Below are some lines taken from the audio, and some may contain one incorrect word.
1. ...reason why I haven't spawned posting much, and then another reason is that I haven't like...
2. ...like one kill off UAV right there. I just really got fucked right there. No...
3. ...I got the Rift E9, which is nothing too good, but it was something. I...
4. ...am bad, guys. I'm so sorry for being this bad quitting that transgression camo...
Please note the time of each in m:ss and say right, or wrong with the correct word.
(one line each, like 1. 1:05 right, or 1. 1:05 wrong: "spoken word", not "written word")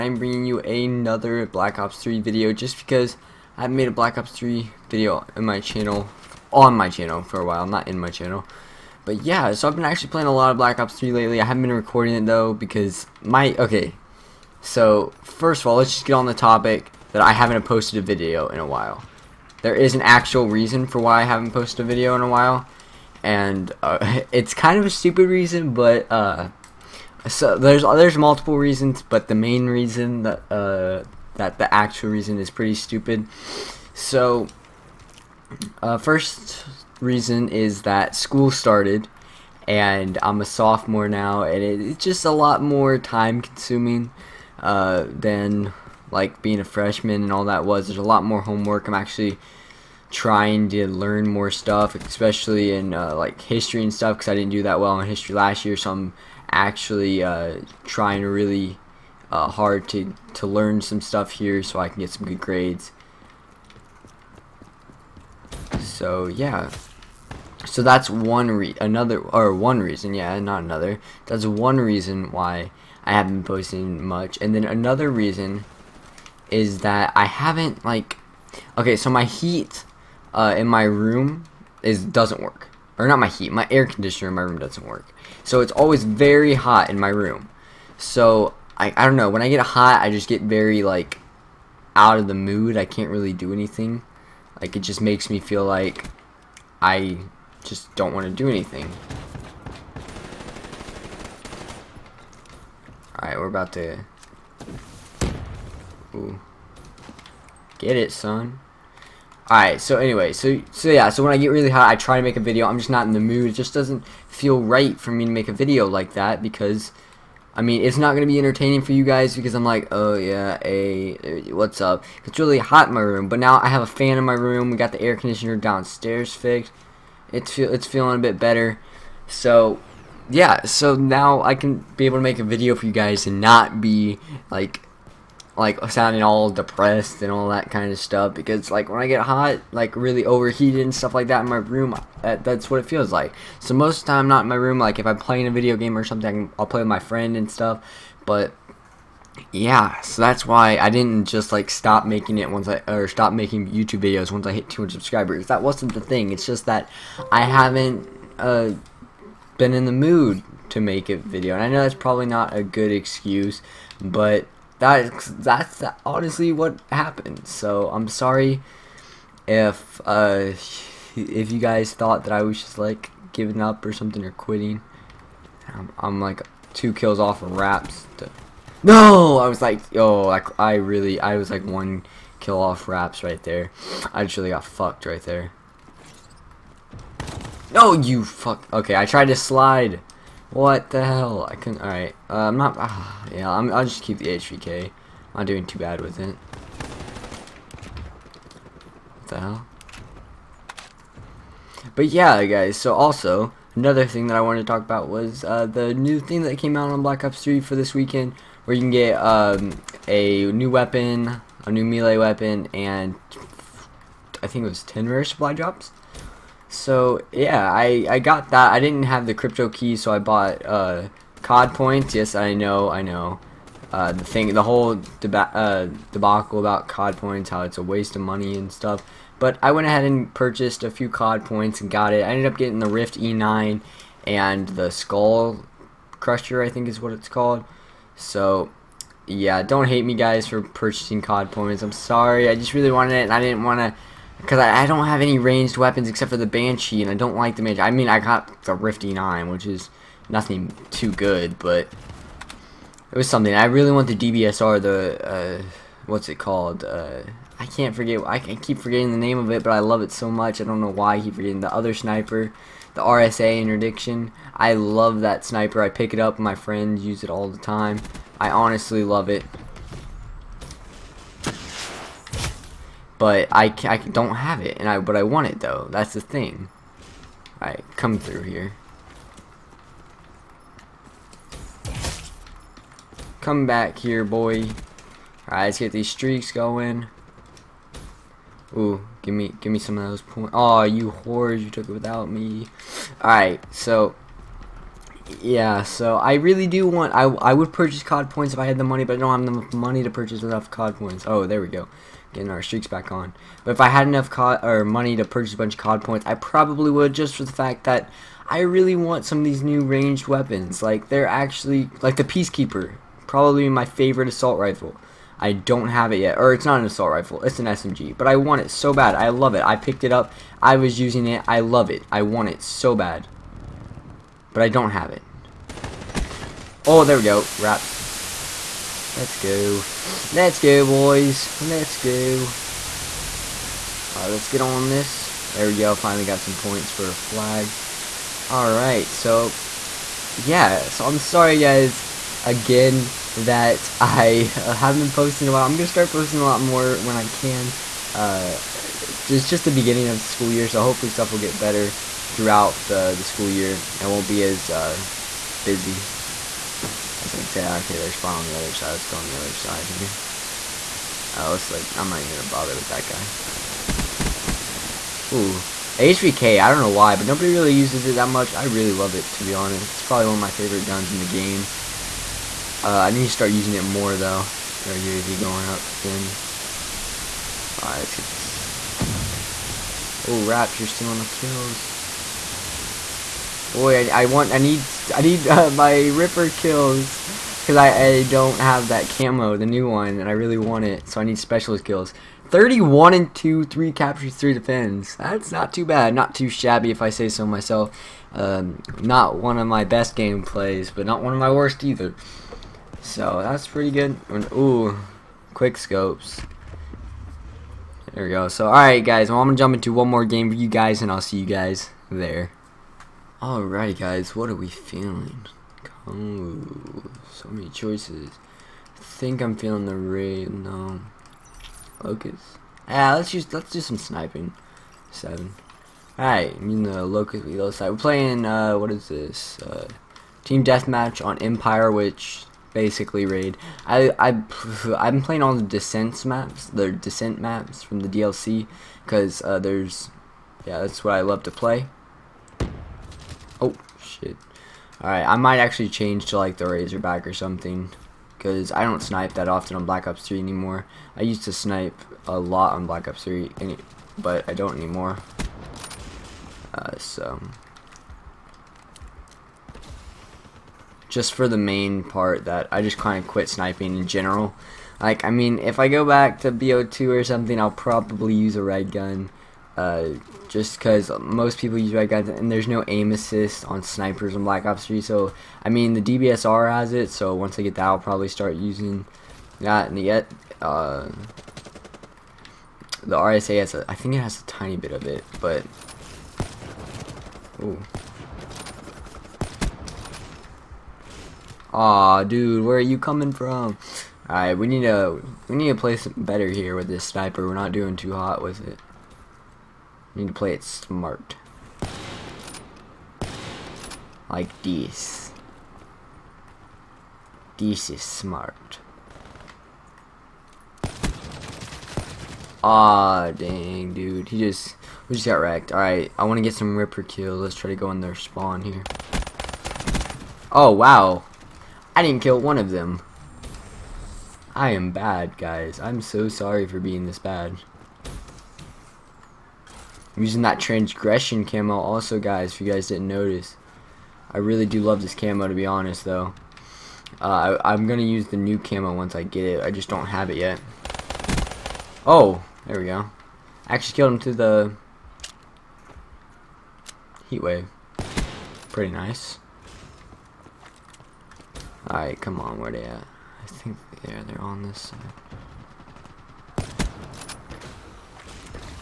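1. 1:11 wrong: "posted", not "spawned"
2. 3:01 wrong: "Raps", not "UAV"
3. 4:08 right
4. 8:44 wrong: "using", not "quitting".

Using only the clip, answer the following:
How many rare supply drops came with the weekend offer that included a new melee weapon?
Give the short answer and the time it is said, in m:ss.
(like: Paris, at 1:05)
10, at 3:34.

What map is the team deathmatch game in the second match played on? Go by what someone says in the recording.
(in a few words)
Empire.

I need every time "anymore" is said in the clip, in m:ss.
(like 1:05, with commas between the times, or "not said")
7:30, 7:34.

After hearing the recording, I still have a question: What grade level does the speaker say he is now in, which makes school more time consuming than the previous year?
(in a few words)
sophomore.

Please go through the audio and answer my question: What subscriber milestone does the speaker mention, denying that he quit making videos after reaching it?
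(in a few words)
200.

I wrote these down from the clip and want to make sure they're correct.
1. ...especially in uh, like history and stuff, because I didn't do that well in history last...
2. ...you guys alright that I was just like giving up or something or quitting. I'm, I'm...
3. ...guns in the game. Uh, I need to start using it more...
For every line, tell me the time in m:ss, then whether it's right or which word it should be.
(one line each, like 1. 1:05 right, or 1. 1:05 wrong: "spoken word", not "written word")
1. 0:51 right
2. 2:51 wrong: "thought", not "alright"
3. 6:10 right.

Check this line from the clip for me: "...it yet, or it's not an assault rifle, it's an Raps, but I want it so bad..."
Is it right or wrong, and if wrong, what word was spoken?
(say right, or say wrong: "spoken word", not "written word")
wrong: "SMG", not "Raps".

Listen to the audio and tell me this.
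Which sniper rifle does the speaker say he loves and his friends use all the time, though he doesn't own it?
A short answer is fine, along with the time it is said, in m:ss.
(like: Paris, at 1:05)
RSA Interdiction, at 4:23.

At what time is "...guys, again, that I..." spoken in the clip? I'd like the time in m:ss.
5:41.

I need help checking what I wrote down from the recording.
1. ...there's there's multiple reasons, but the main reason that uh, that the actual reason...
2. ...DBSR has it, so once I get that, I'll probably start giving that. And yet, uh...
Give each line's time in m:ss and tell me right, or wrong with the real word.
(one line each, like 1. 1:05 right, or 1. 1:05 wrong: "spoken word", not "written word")
1. 0:27 right
2. 7:56 wrong: "using", not "giving".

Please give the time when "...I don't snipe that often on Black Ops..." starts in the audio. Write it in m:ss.
7:28.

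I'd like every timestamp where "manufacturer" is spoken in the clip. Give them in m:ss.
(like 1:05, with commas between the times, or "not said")
not said.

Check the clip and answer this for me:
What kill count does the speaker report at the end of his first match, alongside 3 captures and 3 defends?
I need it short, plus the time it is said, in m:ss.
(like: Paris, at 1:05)
31, at 6:32.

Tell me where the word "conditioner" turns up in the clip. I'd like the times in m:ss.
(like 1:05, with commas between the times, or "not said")
1:23, 2:05.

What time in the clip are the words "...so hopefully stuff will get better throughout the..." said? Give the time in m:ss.
5:50.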